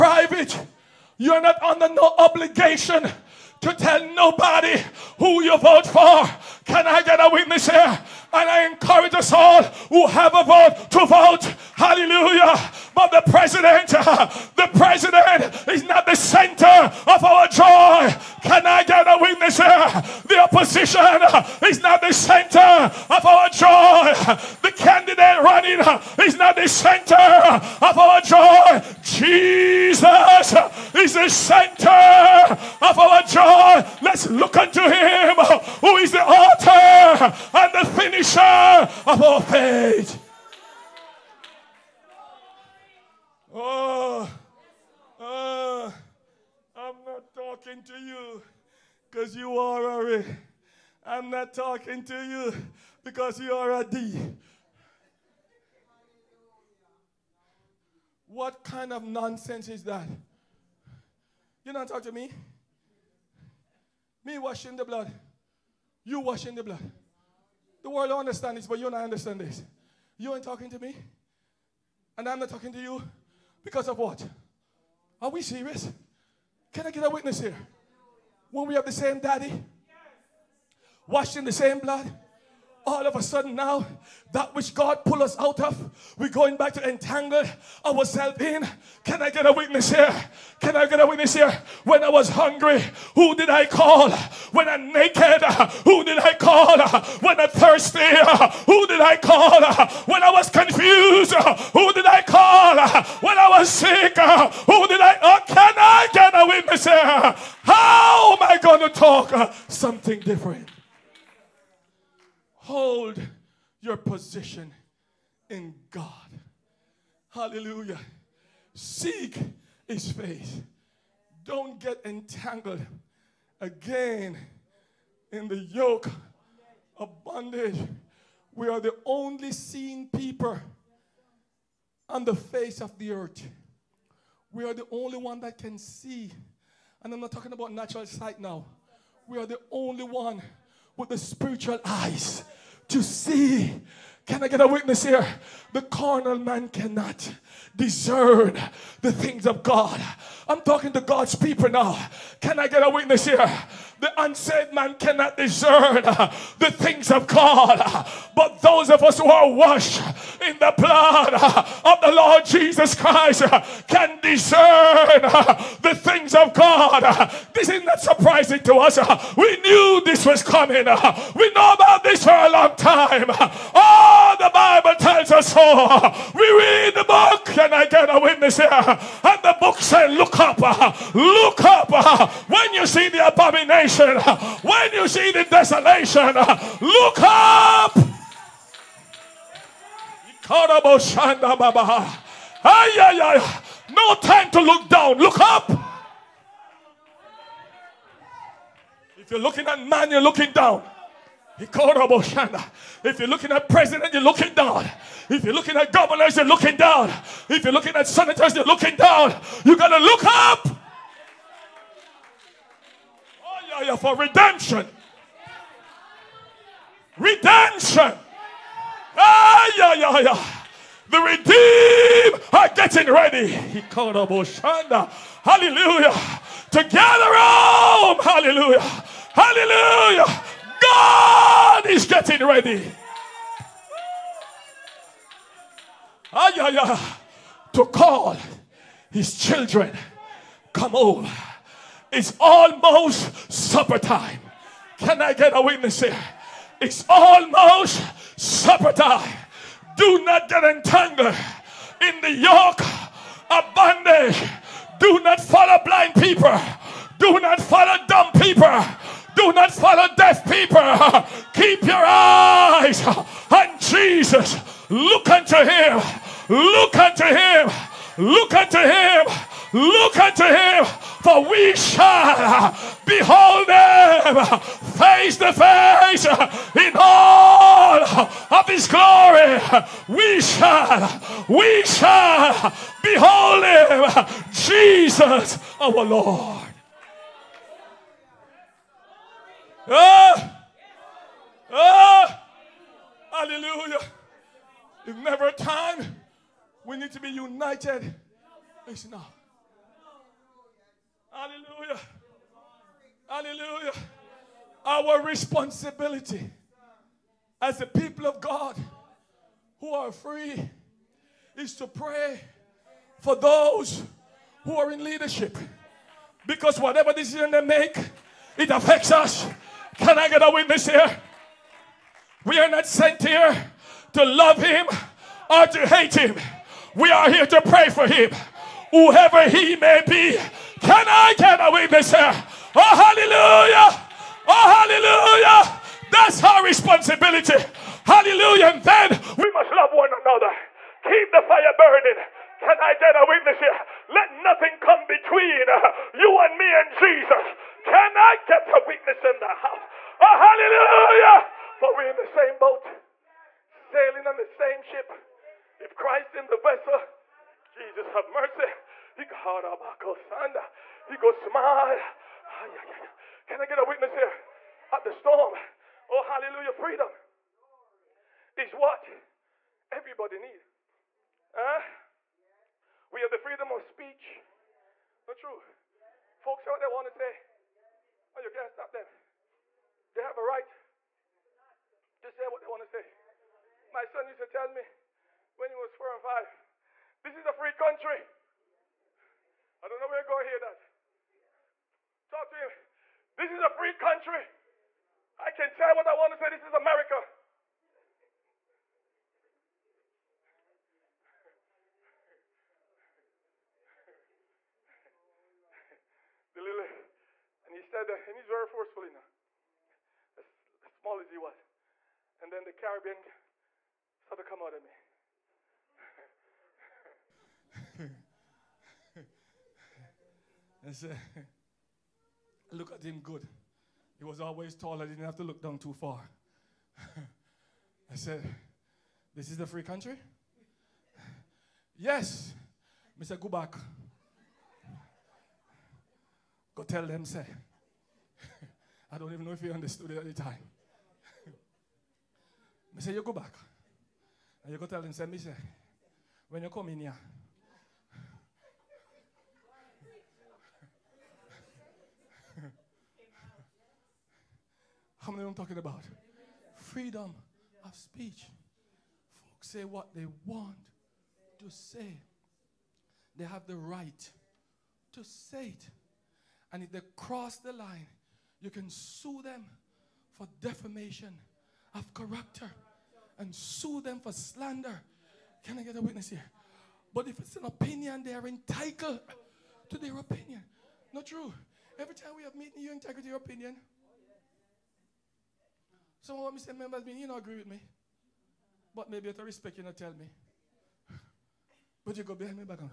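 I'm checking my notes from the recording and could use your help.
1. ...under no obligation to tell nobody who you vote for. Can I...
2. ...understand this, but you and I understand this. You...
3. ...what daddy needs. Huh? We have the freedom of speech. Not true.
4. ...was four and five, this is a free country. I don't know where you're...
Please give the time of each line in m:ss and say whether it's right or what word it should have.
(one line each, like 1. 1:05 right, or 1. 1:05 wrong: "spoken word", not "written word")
1. 0:01 right
2. 1:08 right
3. 6:08 wrong: "everybody", not "daddy"
4. 6:25 right.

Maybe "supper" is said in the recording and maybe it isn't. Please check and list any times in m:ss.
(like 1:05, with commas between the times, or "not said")
4:03, 4:08.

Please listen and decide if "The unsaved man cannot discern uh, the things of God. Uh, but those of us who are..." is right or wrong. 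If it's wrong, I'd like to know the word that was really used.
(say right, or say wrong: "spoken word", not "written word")
right.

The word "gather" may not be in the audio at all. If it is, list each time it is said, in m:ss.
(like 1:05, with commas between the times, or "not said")
3:46.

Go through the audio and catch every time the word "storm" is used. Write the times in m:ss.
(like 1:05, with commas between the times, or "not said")
6:05.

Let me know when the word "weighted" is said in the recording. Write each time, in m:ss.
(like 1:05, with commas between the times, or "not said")
not said.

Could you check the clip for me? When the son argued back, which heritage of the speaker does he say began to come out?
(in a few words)
Caribbean.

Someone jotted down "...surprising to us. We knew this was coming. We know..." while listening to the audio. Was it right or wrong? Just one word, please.
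right.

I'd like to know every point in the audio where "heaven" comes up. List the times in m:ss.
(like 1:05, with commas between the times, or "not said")
not said.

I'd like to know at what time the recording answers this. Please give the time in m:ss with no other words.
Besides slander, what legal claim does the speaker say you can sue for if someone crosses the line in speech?
7:50.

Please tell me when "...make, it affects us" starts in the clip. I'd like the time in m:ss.
5:17.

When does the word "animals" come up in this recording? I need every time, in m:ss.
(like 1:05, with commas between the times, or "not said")
not said.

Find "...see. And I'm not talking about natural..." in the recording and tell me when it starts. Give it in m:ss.
2:15.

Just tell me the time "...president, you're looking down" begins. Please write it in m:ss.
3:23.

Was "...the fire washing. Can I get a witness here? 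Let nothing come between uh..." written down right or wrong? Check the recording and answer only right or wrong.
wrong.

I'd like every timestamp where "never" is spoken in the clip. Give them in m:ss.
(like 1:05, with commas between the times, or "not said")
4:55.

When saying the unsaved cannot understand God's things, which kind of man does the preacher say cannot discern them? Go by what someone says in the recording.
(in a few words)
The carnal man.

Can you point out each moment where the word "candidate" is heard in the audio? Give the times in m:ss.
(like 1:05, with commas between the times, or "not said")
0:24.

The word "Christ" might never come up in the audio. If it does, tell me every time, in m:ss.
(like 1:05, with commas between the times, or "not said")
2:42, 5:55.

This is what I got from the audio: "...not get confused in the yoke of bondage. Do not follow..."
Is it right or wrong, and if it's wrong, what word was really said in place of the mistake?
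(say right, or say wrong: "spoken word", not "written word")
wrong: "entangled", not "confused".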